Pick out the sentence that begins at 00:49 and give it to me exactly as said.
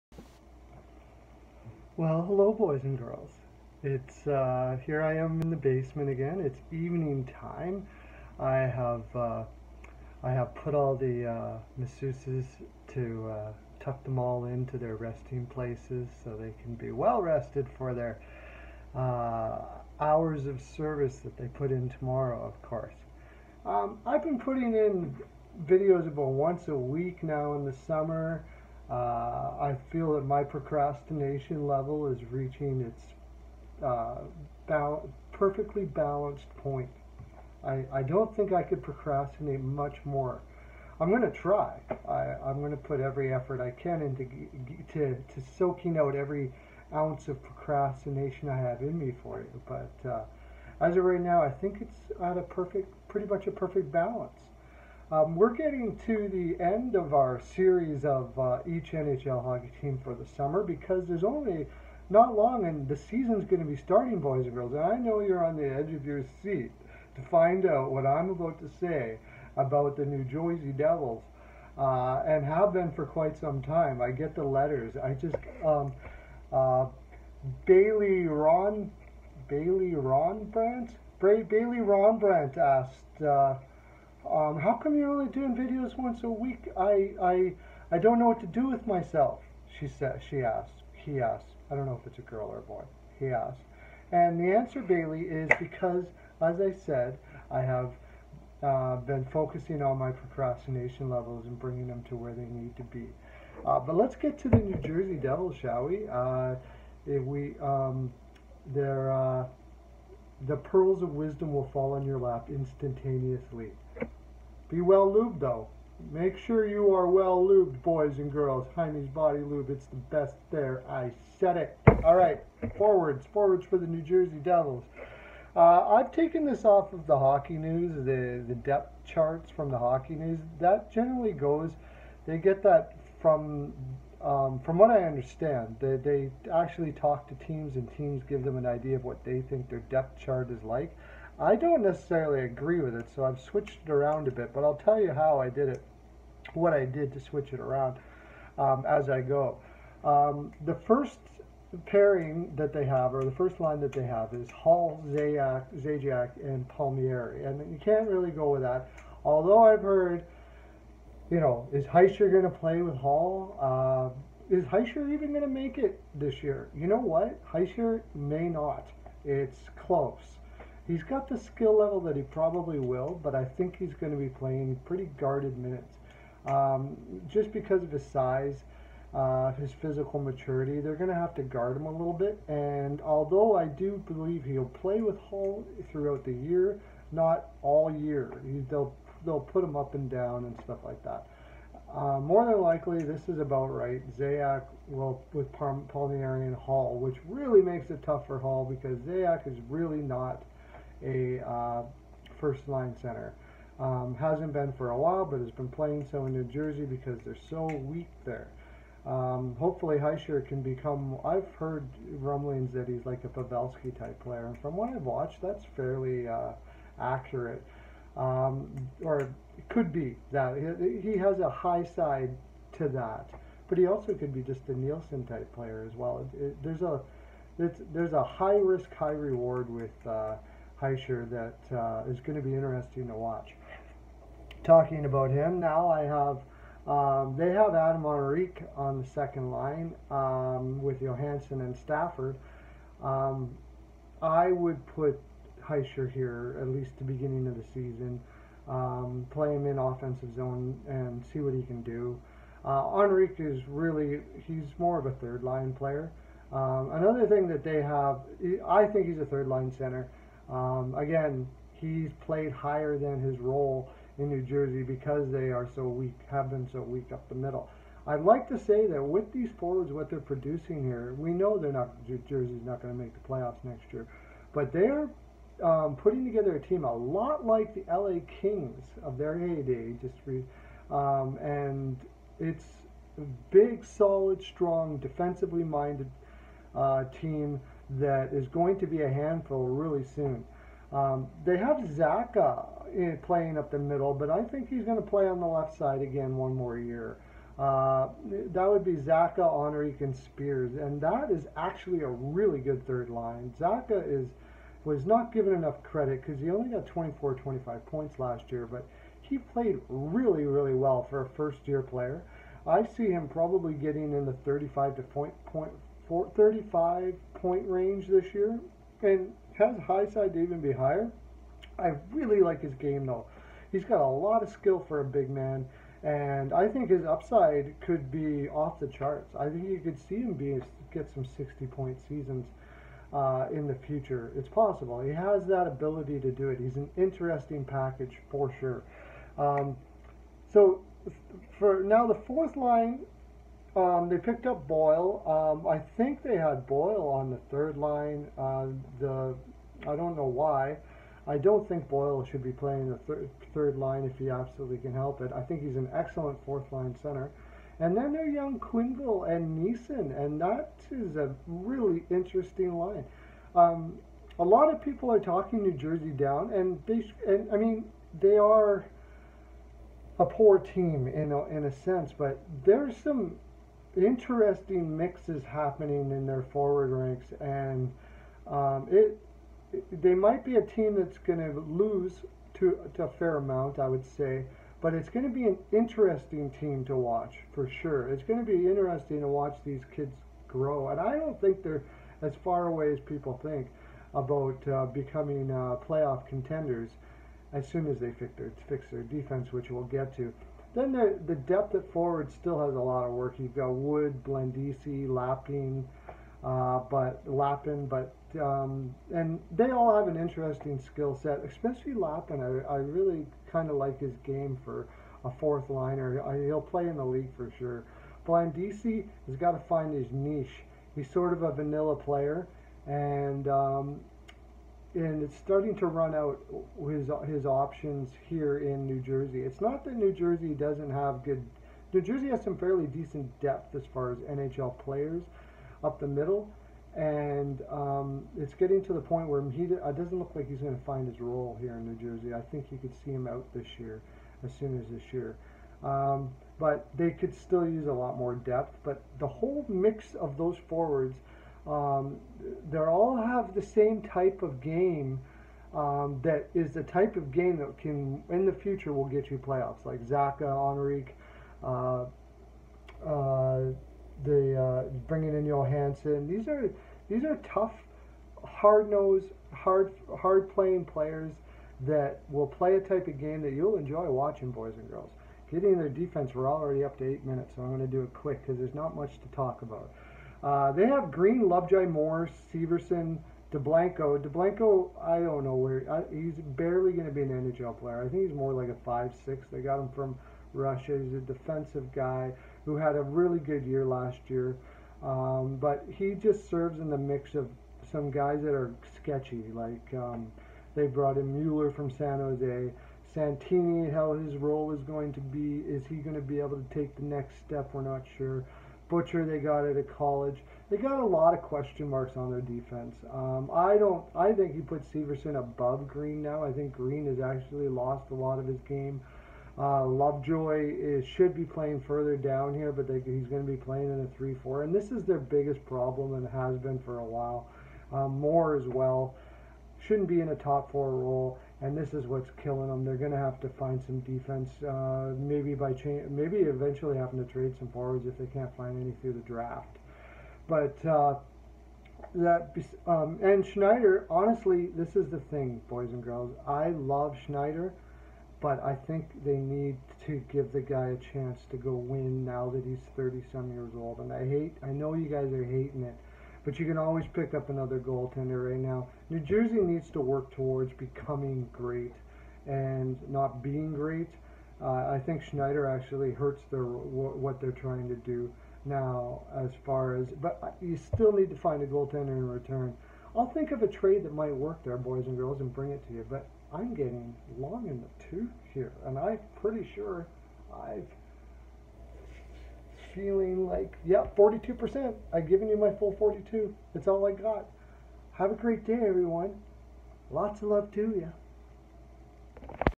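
But uh, as of right now, I think it's at a perfect, pretty much a perfect balance.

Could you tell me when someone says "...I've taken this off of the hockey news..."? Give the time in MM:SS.
02:05.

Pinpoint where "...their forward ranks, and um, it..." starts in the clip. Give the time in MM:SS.
06:16.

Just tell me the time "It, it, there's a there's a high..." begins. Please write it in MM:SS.
03:46.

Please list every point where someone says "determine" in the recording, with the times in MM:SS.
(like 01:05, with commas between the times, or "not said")
not said.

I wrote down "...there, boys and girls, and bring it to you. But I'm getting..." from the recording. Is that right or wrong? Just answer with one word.
right.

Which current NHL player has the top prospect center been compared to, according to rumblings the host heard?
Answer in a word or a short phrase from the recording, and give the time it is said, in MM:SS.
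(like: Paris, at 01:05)
Pavelski, at 03:33.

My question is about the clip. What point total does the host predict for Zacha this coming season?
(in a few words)
35.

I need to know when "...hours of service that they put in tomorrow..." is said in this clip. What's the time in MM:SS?
00:19.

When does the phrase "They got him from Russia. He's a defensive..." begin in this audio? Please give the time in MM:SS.
08:09.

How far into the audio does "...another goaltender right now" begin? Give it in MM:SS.
09:17.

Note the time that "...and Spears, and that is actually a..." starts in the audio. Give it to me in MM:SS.
05:00.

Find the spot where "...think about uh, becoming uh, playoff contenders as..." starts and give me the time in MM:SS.
06:33.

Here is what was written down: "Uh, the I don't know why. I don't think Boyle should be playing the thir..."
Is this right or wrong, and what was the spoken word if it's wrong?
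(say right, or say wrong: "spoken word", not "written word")
right.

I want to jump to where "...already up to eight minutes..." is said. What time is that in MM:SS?
07:56.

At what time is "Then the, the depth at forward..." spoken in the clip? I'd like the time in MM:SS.
06:40.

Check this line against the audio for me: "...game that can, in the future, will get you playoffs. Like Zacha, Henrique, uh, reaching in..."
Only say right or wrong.
wrong.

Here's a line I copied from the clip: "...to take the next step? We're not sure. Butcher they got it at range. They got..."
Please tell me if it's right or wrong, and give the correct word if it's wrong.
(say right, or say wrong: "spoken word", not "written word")
wrong: "college", not "range".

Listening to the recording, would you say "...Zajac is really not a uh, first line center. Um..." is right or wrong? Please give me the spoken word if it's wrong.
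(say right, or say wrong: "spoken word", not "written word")
right.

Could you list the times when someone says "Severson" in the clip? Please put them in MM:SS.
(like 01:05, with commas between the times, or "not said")
08:02, 08:34.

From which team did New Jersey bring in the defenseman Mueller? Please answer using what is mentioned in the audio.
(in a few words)
San Jose.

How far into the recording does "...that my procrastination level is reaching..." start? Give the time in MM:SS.
00:30.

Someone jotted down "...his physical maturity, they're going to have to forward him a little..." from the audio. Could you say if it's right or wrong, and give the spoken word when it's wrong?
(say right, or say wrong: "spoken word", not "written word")
wrong: "guard", not "forward".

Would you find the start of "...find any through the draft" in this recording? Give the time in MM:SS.
08:58.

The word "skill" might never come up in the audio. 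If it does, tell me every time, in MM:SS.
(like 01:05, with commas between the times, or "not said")
02:51, 05:24, 06:50.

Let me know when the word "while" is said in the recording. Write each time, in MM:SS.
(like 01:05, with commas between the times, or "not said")
03:24, 08:47.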